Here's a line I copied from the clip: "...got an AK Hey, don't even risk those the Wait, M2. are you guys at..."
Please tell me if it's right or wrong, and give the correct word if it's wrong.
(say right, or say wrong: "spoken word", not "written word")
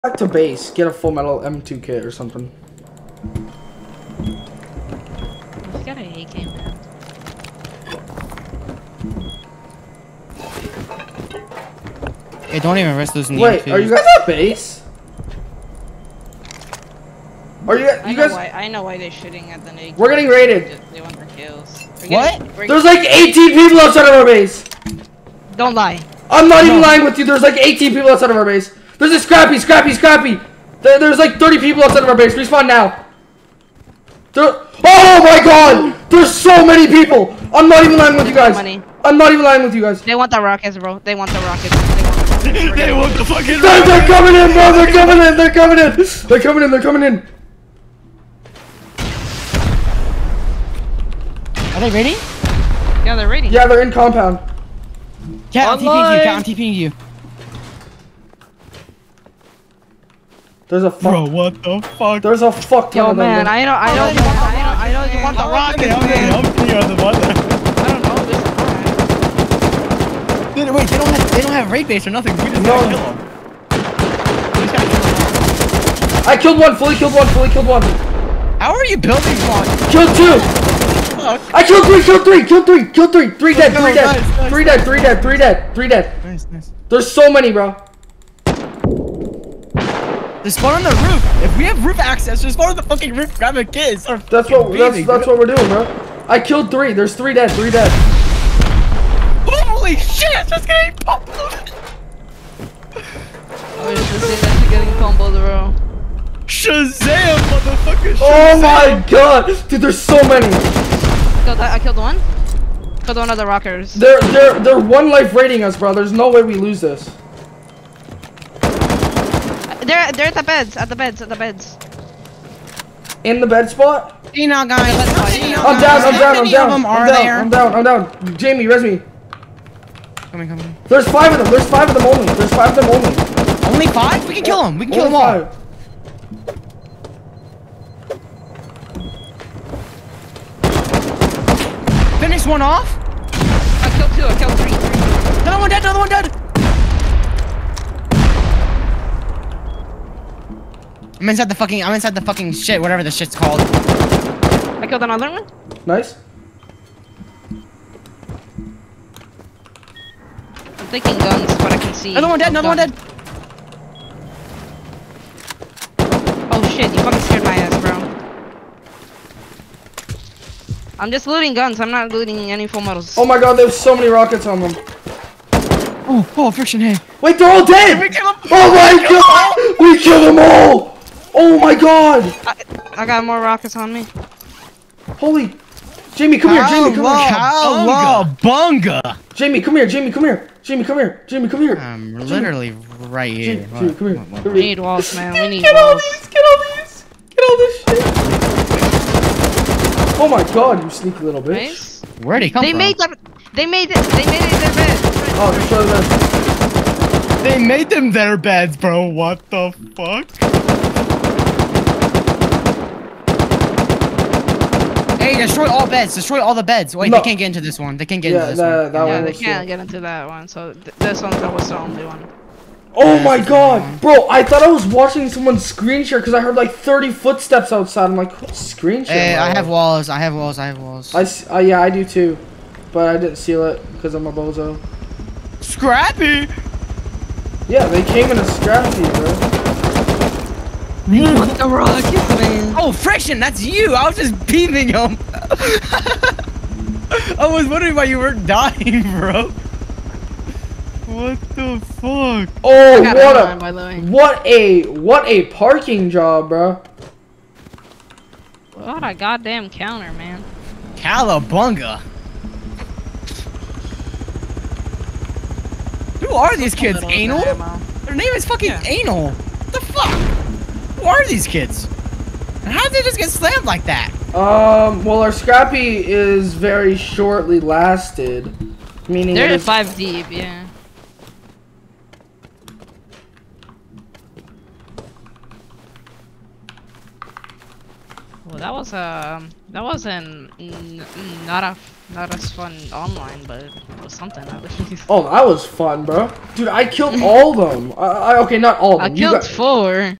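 right.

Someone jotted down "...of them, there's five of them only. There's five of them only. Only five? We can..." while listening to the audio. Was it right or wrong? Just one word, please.
right.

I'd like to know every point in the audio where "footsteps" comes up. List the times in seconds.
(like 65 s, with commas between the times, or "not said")
227 s.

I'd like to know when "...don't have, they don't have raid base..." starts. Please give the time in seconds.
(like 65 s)
70 s.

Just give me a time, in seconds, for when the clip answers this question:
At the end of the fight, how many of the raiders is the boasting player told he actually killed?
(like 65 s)
299 s.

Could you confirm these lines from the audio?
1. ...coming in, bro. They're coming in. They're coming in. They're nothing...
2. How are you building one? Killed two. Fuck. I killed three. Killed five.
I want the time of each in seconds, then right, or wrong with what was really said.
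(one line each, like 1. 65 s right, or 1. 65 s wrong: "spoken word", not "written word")
1. 44 s wrong: "coming", not "nothing"
2. 78 s wrong: "three", not "five".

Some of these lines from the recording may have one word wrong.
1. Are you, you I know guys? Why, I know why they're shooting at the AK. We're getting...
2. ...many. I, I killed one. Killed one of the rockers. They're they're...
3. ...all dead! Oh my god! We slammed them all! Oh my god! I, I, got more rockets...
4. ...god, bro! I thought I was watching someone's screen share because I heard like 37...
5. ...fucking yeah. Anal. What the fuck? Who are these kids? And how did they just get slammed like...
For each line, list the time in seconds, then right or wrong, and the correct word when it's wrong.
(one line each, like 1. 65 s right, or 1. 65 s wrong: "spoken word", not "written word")
1. 17 s right
2. 110 s right
3. 177 s wrong: "killed", not "slammed"
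4. 223 s wrong: "30", not "37"
5. 268 s right.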